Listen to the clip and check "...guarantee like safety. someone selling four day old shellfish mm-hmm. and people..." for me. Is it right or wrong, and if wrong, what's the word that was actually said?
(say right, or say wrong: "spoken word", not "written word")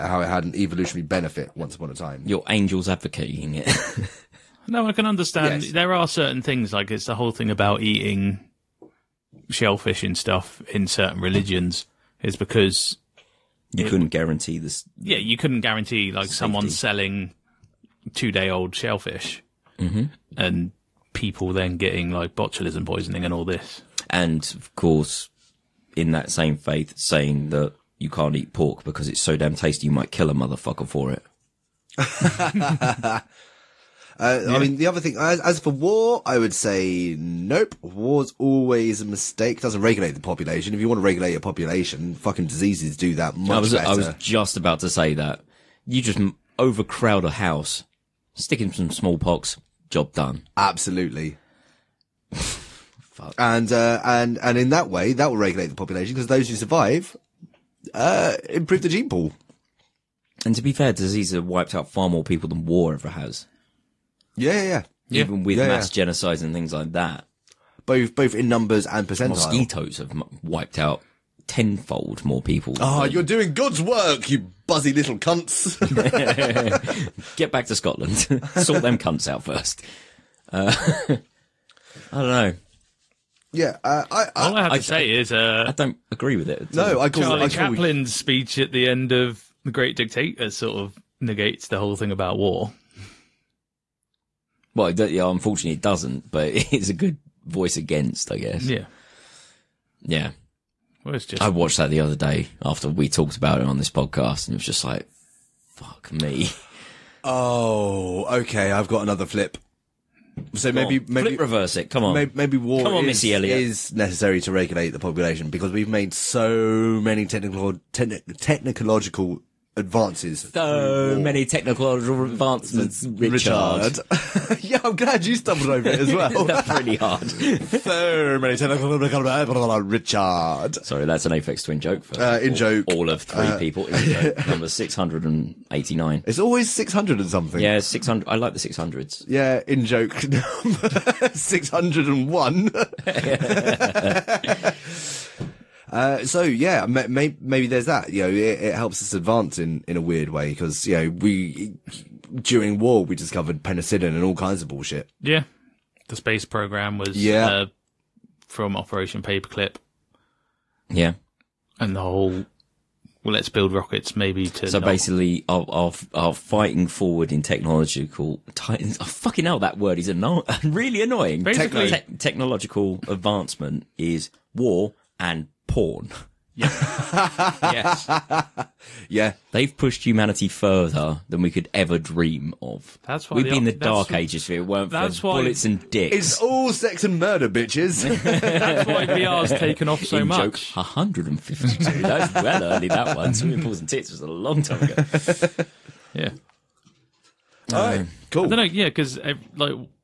wrong: "two", not "four".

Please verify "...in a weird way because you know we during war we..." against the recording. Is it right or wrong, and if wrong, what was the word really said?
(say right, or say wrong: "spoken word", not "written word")
right.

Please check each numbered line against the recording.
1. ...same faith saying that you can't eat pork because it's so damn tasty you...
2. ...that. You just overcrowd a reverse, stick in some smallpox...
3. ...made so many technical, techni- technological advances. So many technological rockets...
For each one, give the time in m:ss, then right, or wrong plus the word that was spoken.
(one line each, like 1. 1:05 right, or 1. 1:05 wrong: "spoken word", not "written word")
1. 0:26 right
2. 0:45 wrong: "house", not "reverse"
3. 1:55 wrong: "advancements", not "rockets".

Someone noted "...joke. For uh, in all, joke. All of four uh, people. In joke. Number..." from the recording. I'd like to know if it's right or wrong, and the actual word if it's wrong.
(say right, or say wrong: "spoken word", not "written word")
wrong: "three", not "four".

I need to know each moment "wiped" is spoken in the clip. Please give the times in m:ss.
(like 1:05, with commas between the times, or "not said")
1:01, 1:10.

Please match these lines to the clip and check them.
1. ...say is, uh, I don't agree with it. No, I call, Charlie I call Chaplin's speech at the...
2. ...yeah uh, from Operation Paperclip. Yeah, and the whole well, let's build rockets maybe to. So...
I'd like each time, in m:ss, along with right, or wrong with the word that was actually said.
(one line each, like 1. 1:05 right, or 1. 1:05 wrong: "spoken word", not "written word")
1. 1:24 right
2. 2:37 right.